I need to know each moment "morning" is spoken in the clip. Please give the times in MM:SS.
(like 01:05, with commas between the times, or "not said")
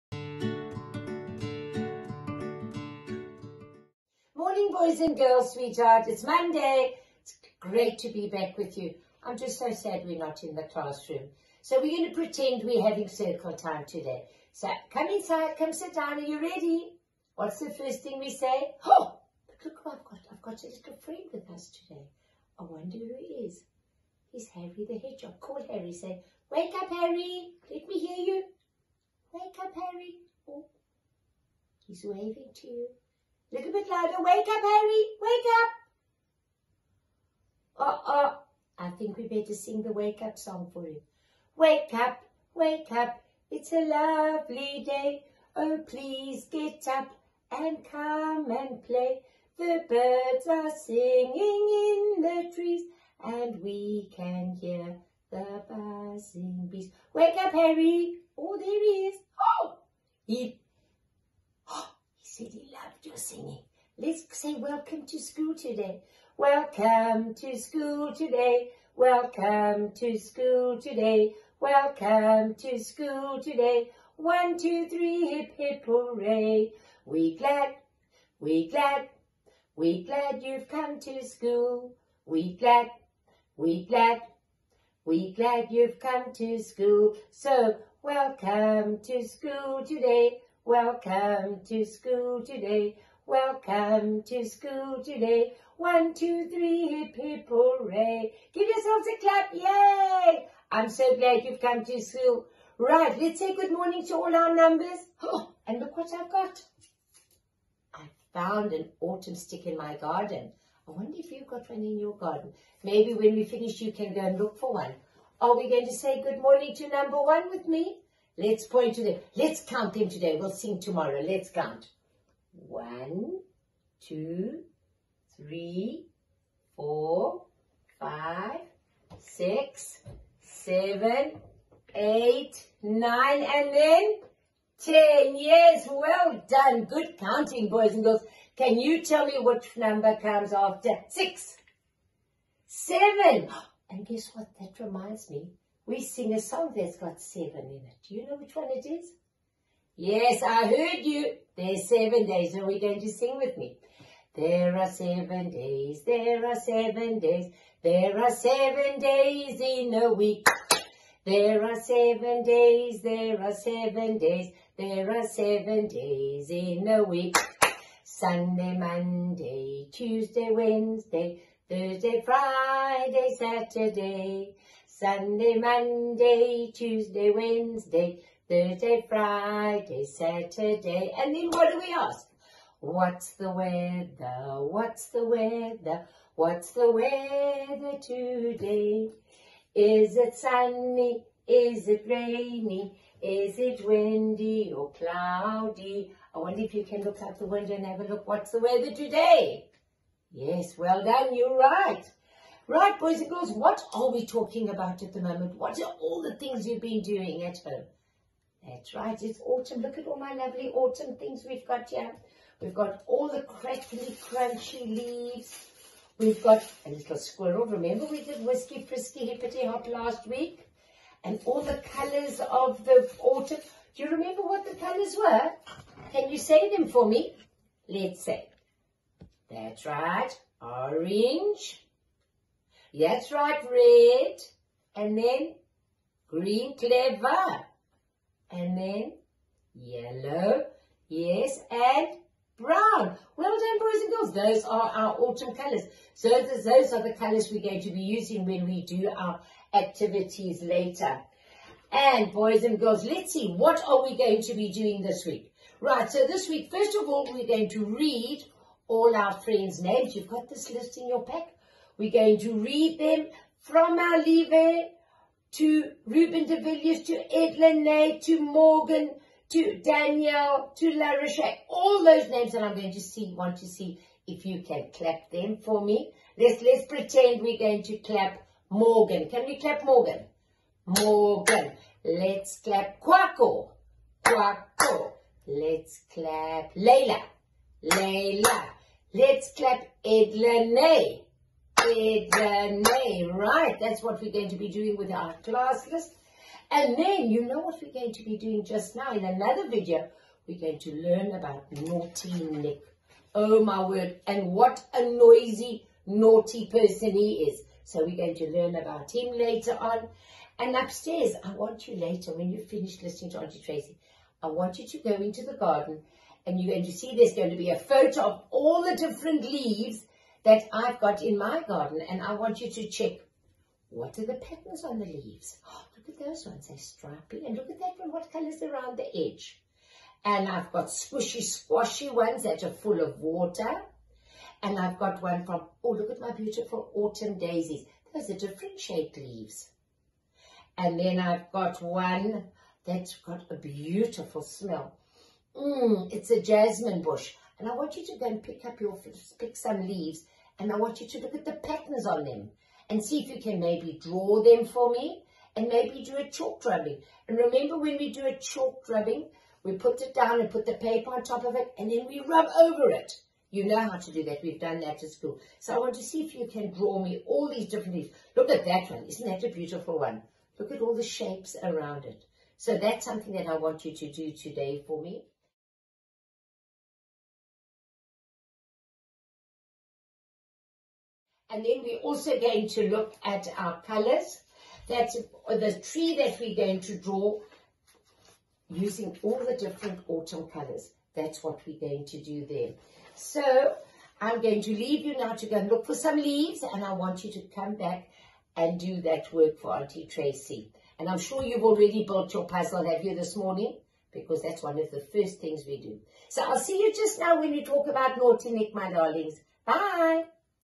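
00:04, 01:43, 01:56, 06:43.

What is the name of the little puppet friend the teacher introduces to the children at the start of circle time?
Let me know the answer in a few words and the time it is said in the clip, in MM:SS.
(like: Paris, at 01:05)
Harry the Hedgehog, at 00:24.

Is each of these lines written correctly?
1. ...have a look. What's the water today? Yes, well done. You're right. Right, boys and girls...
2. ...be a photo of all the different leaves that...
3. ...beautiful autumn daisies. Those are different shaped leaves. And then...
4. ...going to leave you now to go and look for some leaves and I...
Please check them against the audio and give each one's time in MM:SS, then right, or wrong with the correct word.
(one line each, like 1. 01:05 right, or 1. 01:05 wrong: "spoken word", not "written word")
1. 03:17 wrong: "weather", not "water"
2. 05:17 right
3. 05:36 right
4. 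06:34 right.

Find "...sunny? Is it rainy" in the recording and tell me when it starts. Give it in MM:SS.
03:10.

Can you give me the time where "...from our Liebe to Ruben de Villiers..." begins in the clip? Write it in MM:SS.
04:23.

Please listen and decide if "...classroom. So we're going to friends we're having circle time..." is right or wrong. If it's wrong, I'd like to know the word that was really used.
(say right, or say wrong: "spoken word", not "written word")
wrong: "pretend", not "friends".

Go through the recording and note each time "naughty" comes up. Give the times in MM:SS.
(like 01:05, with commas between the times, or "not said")
05:01, 05:06, 06:48.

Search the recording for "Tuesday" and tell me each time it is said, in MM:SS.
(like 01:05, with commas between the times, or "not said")
02:49, 02:56.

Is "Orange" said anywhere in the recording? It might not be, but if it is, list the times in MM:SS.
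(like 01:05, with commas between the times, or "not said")
03:50.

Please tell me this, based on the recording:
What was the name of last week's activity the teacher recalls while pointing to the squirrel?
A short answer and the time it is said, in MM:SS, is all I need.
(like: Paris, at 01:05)
Whiskey Frisky Hippity Hop, at 03:38.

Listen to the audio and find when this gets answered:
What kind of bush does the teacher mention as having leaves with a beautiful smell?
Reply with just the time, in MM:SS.
05:46.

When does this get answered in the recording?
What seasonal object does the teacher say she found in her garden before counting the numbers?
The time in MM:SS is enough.
01:48.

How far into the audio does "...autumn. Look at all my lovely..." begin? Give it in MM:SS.
03:29.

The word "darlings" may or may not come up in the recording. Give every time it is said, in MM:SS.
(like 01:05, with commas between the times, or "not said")
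06:48.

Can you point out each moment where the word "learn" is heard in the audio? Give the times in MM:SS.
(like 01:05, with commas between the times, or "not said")
05:00, 05:08.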